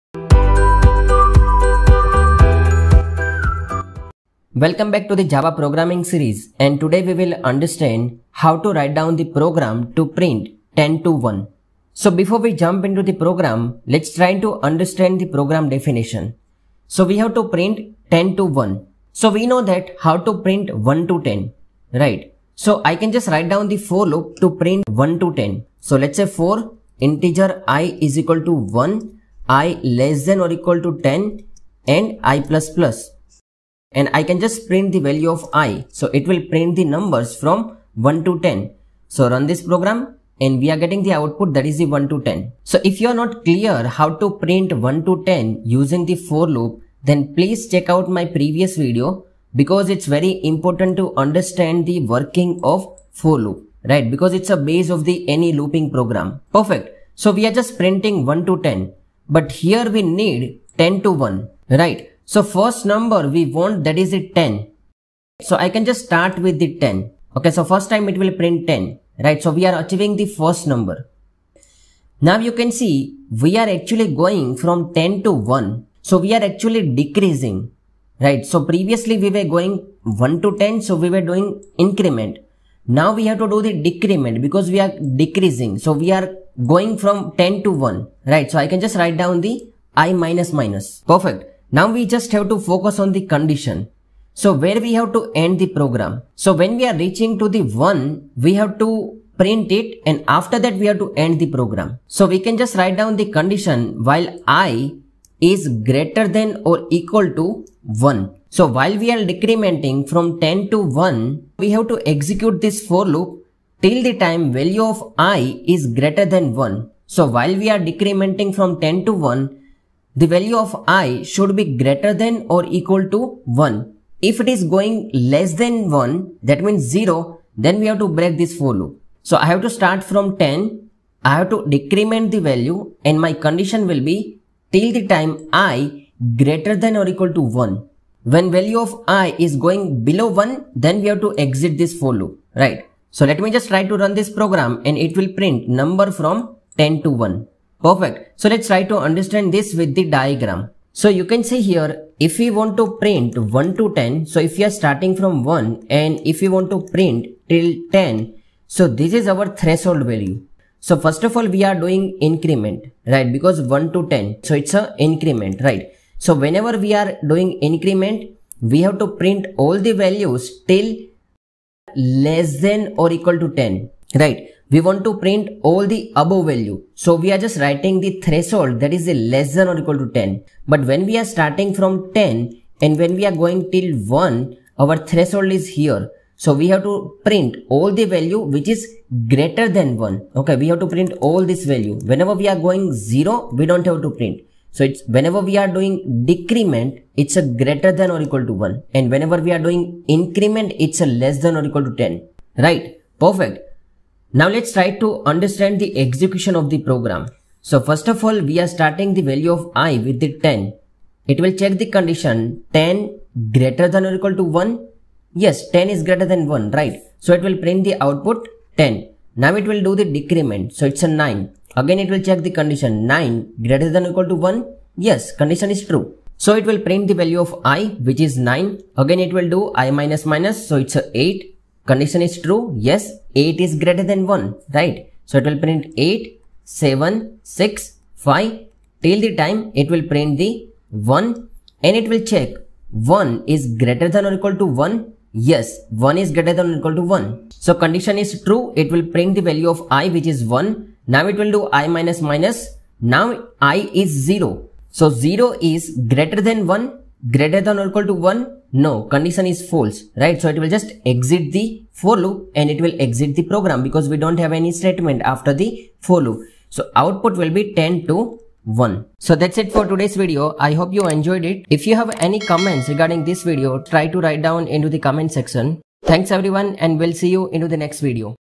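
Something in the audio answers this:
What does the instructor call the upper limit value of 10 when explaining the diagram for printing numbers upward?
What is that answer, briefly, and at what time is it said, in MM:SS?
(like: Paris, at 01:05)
threshold value, at 02:39.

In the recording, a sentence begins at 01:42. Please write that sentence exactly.
So we can just write down the condition while i is greater than or equal to 1.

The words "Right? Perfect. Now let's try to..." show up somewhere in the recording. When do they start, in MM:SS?
03:22.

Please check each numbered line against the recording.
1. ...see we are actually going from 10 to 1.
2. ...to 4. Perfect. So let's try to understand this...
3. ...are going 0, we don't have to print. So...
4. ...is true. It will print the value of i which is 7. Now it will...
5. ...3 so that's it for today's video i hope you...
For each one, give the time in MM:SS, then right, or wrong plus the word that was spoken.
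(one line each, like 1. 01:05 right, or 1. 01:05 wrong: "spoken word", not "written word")
1. 01:12 right
2. 02:27 wrong: "1", not "4"
3. 03:12 right
4. 04:08 wrong: "1", not "7"
5. 04:28 wrong: "1", not "3".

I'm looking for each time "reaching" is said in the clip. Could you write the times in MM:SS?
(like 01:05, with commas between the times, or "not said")
01:36.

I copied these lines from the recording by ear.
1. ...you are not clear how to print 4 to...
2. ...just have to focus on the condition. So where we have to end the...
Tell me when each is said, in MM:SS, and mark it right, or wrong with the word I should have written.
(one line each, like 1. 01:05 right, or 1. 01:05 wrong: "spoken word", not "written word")
1. 00:43 wrong: "1", not "4"
2. 01:32 right.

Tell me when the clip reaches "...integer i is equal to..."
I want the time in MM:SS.
00:26.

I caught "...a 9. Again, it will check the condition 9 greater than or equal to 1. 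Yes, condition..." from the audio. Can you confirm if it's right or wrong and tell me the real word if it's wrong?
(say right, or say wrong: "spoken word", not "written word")
right.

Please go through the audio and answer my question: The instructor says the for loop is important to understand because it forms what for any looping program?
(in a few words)
base.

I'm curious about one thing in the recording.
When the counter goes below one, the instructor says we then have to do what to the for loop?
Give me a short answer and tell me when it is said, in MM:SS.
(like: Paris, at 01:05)
break, at 02:08.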